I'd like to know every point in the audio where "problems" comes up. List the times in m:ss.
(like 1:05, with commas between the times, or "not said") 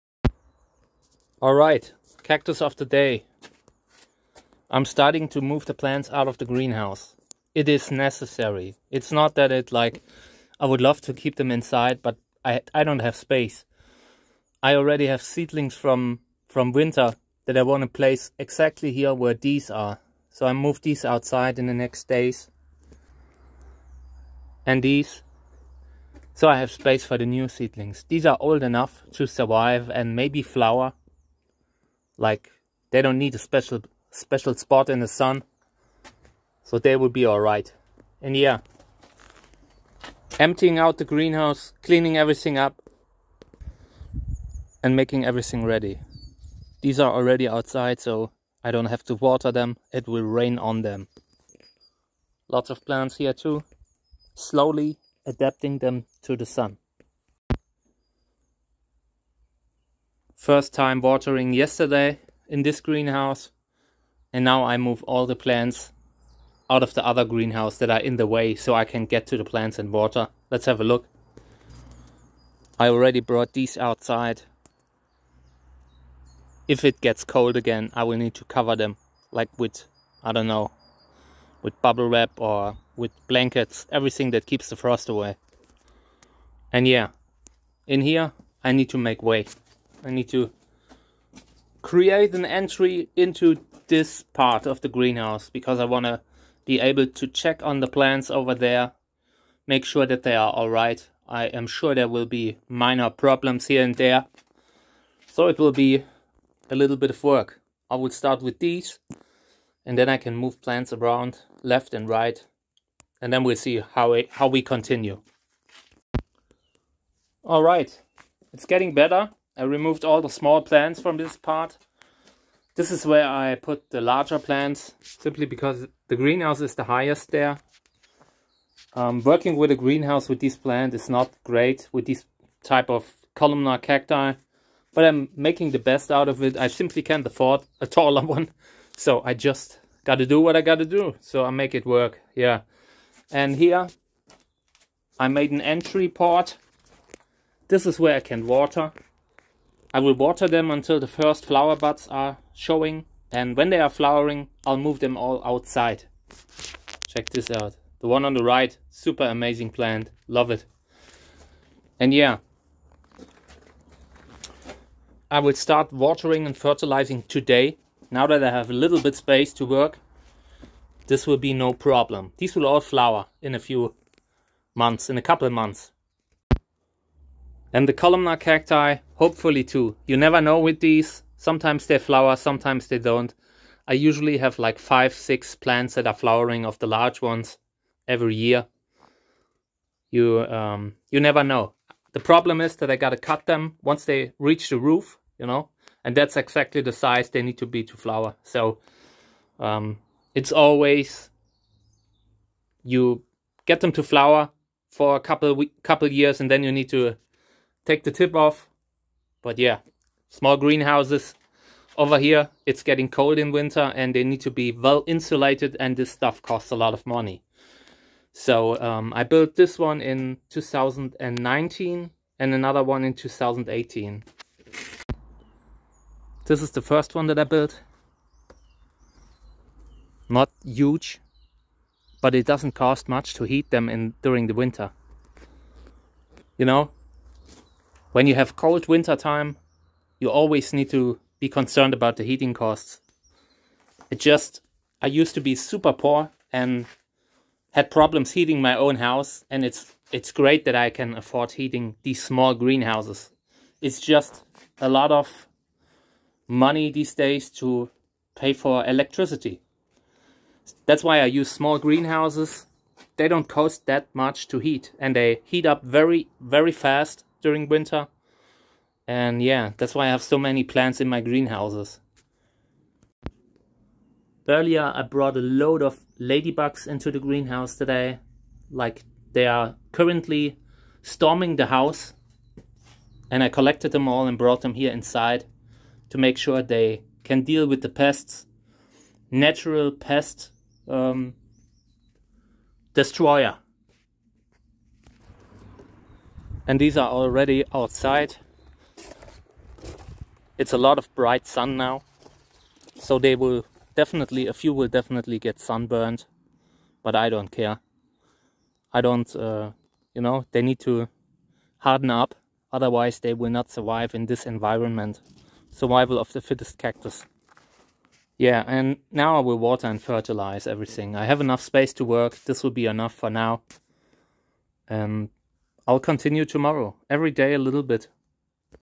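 1:43, 2:51, 3:12, 4:07.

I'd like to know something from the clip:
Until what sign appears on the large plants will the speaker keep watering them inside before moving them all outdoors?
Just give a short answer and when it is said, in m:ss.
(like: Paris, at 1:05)
first flower buds, at 2:31.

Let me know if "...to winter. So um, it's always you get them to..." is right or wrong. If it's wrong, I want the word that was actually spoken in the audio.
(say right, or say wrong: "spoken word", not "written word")
wrong: "flower", not "winter".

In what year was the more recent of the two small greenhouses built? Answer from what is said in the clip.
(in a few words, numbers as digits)
2019.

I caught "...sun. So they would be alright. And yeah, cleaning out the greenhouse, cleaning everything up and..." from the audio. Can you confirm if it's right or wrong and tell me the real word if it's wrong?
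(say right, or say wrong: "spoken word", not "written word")
wrong: "emptying", not "cleaning".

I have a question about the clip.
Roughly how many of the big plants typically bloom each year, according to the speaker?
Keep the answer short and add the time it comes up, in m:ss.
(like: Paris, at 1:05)
5 or 6, at 3:04.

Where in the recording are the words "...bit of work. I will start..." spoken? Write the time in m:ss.
1:46.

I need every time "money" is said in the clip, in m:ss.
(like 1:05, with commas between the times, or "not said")
3:37, 4:16.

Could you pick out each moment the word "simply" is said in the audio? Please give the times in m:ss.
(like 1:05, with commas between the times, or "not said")
2:05, 2:16.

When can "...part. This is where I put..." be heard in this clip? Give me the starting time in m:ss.
2:01.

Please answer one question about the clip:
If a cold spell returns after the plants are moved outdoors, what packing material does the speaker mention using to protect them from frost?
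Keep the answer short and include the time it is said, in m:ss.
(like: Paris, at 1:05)
bubble wrap, at 1:21.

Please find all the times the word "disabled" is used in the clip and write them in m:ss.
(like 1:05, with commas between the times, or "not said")
not said.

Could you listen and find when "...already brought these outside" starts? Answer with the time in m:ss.
1:12.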